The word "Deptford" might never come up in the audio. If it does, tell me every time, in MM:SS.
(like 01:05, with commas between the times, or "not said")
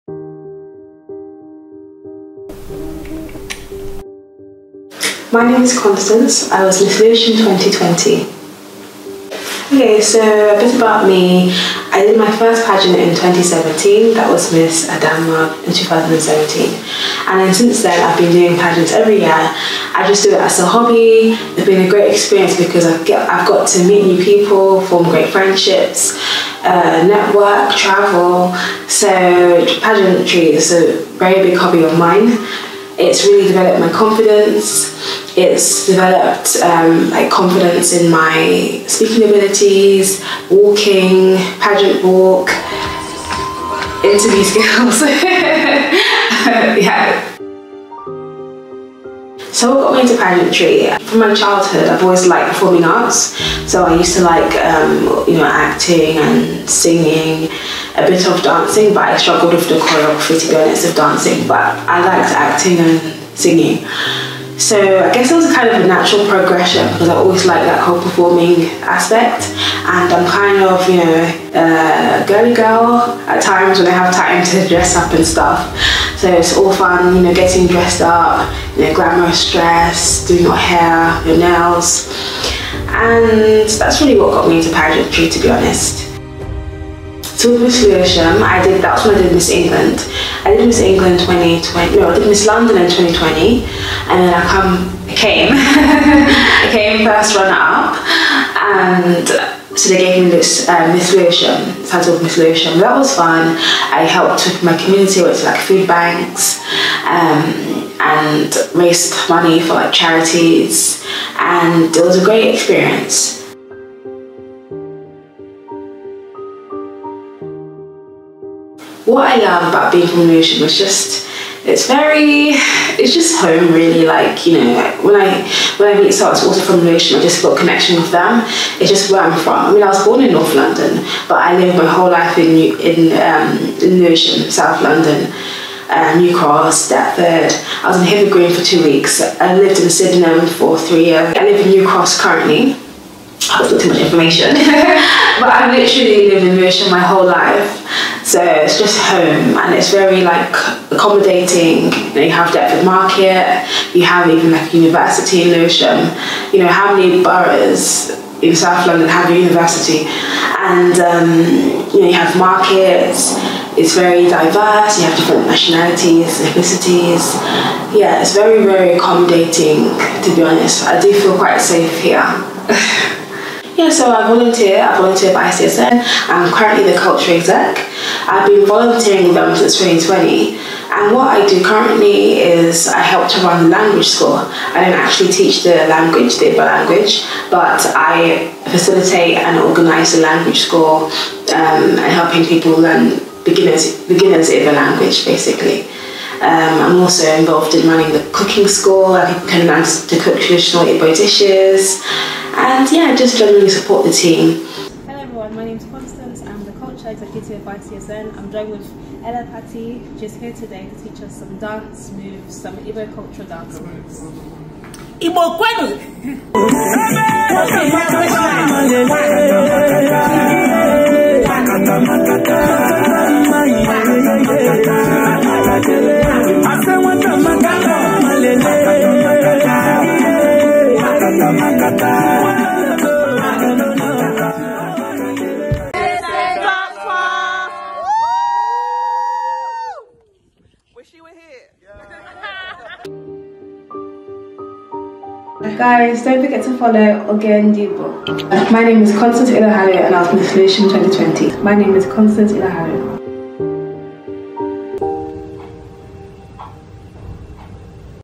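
02:16, 02:32.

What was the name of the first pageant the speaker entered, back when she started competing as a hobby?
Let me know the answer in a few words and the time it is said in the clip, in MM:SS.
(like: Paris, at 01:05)
Miss Adama, at 00:14.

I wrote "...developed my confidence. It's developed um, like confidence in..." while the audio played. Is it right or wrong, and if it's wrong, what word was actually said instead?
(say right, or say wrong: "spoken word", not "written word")
right.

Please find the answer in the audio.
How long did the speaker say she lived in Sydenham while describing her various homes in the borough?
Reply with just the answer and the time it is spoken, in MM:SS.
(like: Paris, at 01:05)
three years, at 02:20.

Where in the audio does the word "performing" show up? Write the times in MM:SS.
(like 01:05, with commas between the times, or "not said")
00:52, 01:08.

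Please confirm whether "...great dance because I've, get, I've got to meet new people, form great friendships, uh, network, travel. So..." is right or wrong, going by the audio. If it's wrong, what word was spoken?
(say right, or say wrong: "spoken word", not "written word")
wrong: "experience", not "dance".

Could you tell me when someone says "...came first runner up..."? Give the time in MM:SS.
01:36.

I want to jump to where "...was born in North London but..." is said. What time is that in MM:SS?
02:09.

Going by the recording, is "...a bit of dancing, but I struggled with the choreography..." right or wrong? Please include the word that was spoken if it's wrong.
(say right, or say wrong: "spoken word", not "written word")
right.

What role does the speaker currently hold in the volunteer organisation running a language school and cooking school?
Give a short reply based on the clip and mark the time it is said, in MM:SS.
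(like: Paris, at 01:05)
culture exec, at 02:56.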